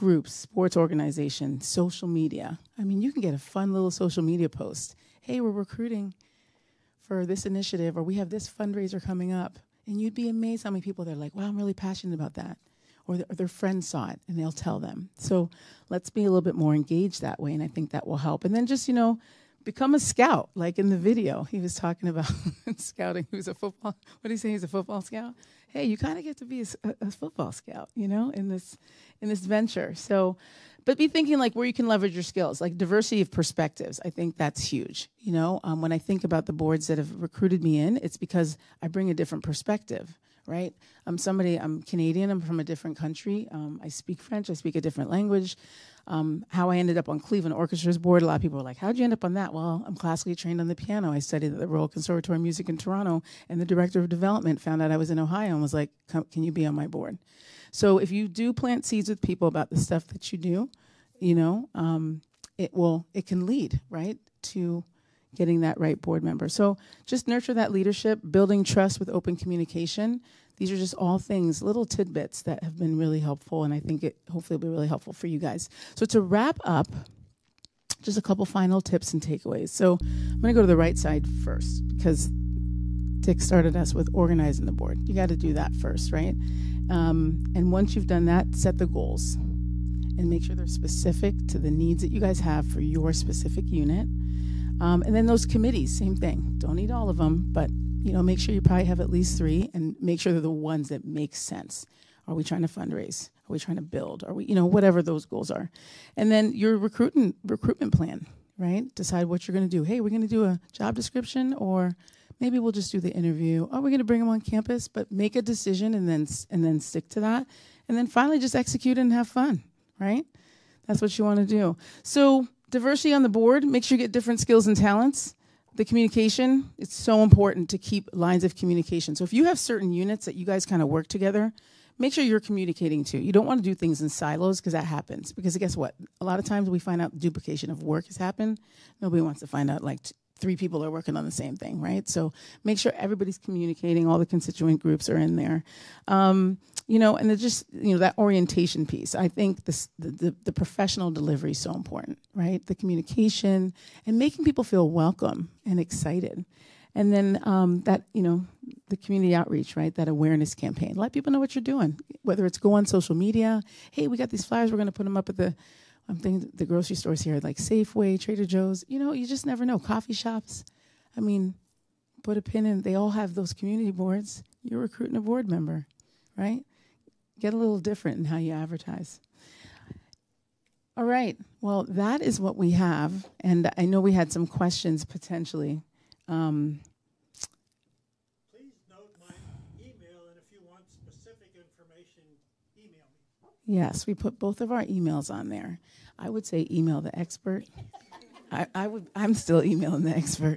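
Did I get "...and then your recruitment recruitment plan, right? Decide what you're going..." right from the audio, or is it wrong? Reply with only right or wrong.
right.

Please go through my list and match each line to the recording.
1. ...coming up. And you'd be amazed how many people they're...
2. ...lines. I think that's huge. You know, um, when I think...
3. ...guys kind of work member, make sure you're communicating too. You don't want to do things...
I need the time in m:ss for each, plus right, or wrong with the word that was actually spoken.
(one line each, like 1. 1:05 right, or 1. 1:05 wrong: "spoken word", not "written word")
1. 0:09 right
2. 0:33 wrong: "perspectives", not "lines"
3. 2:10 wrong: "together", not "member".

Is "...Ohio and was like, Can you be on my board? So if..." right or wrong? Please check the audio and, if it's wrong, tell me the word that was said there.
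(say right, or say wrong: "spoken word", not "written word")
right.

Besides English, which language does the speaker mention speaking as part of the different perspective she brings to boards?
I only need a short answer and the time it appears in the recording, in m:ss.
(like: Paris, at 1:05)
French, at 0:44.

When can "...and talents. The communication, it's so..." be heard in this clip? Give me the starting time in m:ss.
2:04.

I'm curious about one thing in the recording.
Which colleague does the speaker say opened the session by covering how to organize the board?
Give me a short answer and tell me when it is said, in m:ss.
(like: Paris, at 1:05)
Dick, at 1:23.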